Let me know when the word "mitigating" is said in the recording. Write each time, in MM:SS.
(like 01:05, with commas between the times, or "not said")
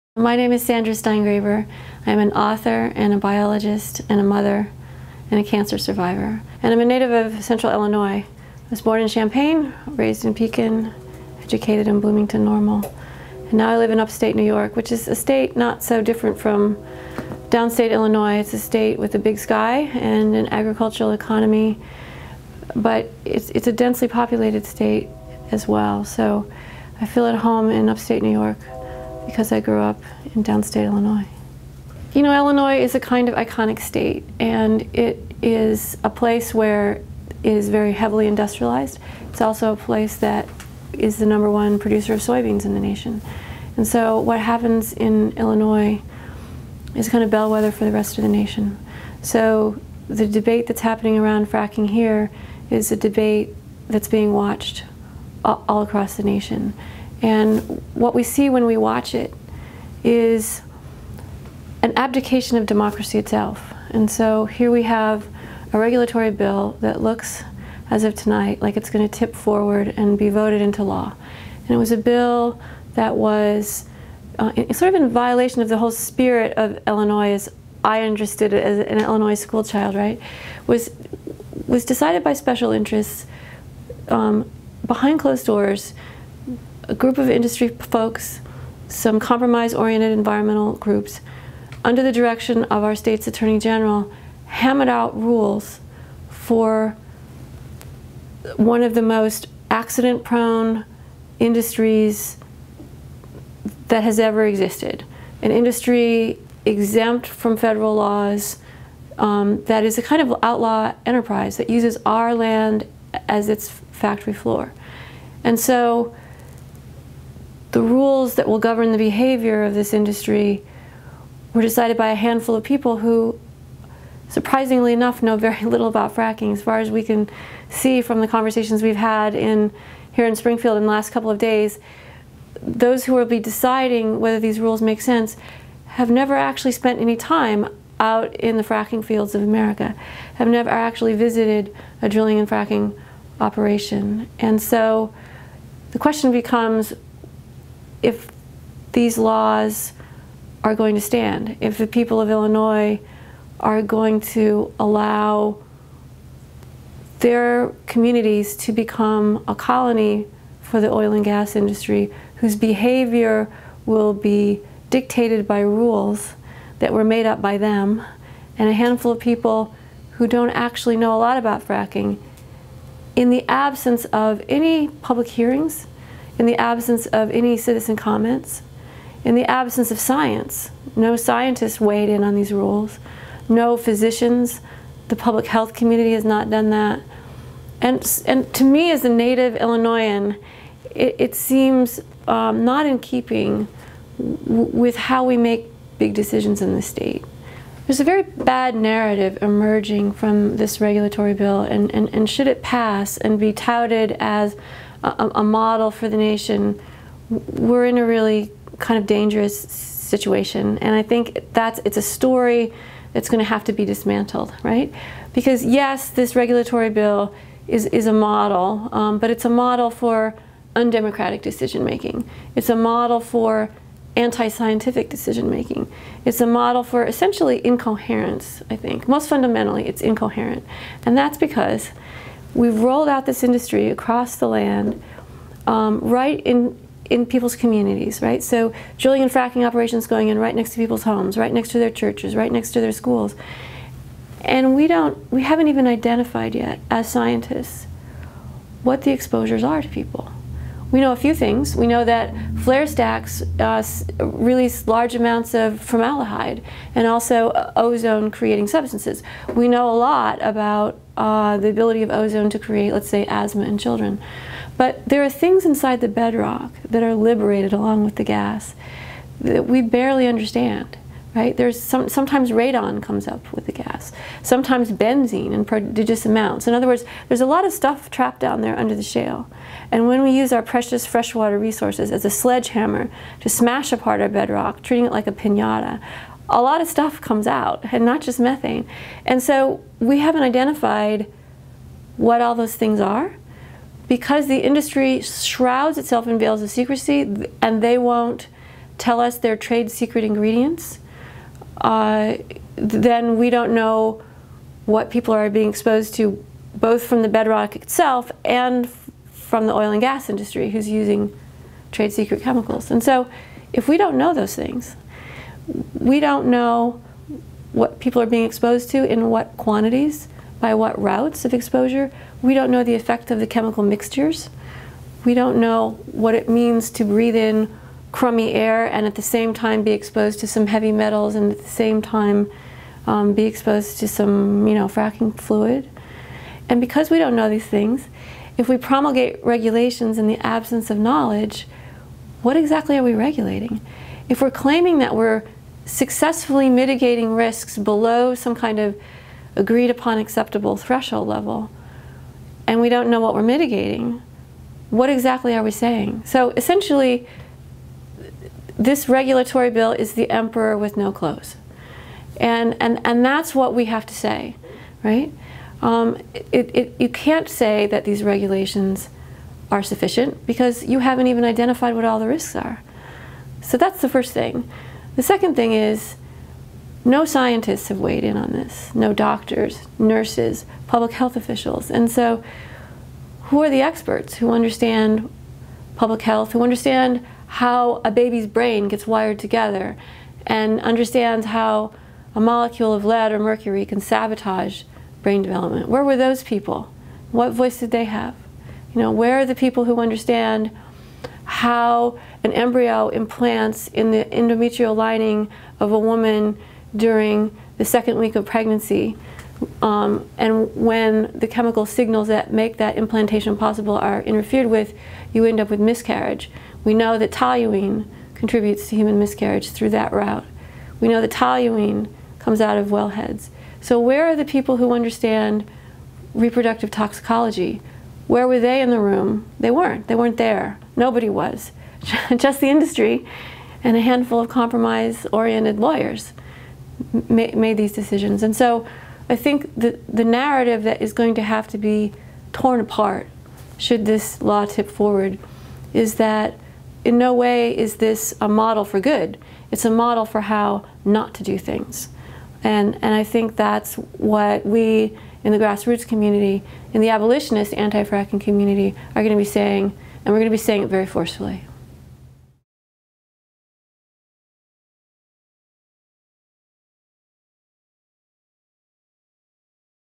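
05:46, 05:53.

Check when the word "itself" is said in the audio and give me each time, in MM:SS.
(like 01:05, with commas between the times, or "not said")
01:03, 04:55, 05:07.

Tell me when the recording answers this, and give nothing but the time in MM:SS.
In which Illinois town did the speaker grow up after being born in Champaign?
00:10.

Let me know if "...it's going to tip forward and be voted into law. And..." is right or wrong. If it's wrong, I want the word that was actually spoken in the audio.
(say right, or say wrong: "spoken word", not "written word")
right.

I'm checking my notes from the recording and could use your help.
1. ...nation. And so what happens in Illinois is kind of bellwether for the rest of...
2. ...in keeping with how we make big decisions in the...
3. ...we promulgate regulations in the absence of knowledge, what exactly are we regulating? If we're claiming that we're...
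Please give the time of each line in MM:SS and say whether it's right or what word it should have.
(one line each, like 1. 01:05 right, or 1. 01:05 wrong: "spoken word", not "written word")
1. 00:42 right
2. 03:12 right
3. 05:38 right.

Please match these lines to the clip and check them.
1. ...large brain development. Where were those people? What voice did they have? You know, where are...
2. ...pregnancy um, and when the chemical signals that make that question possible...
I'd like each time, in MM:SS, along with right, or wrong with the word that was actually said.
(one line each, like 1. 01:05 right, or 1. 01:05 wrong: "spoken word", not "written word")
1. 06:33 wrong: "sabotage", not "large"
2. 06:48 wrong: "implantation", not "question".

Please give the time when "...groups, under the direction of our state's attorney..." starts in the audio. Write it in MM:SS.
01:30.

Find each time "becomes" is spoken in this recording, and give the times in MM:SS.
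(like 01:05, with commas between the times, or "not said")
02:26, 02:38.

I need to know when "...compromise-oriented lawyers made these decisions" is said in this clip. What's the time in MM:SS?
07:14.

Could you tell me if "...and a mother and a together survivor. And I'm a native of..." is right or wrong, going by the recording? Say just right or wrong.
wrong.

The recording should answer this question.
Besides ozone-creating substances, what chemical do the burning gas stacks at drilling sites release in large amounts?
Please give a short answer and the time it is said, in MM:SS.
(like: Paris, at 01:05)
Formaldehyde, at 04:15.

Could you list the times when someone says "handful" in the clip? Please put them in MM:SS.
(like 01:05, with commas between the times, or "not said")
02:02, 02:48, 07:14.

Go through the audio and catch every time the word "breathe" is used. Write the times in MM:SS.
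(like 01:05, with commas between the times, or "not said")
05:27.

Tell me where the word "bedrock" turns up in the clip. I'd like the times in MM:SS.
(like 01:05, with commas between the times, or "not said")
04:26, 04:44, 05:07.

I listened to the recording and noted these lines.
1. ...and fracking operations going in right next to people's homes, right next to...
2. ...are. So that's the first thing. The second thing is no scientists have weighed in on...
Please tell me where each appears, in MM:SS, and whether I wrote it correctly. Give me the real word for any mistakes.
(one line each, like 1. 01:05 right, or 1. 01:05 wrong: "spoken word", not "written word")
1. 03:59 right
2. 06:12 right.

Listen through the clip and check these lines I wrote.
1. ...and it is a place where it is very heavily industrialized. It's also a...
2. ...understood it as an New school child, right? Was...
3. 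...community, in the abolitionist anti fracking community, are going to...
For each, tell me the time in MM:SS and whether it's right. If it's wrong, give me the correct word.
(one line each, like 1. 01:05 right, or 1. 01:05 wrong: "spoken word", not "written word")
1. 00:34 right
2. 01:18 wrong: "Illinois", not "New"
3. 07:36 right.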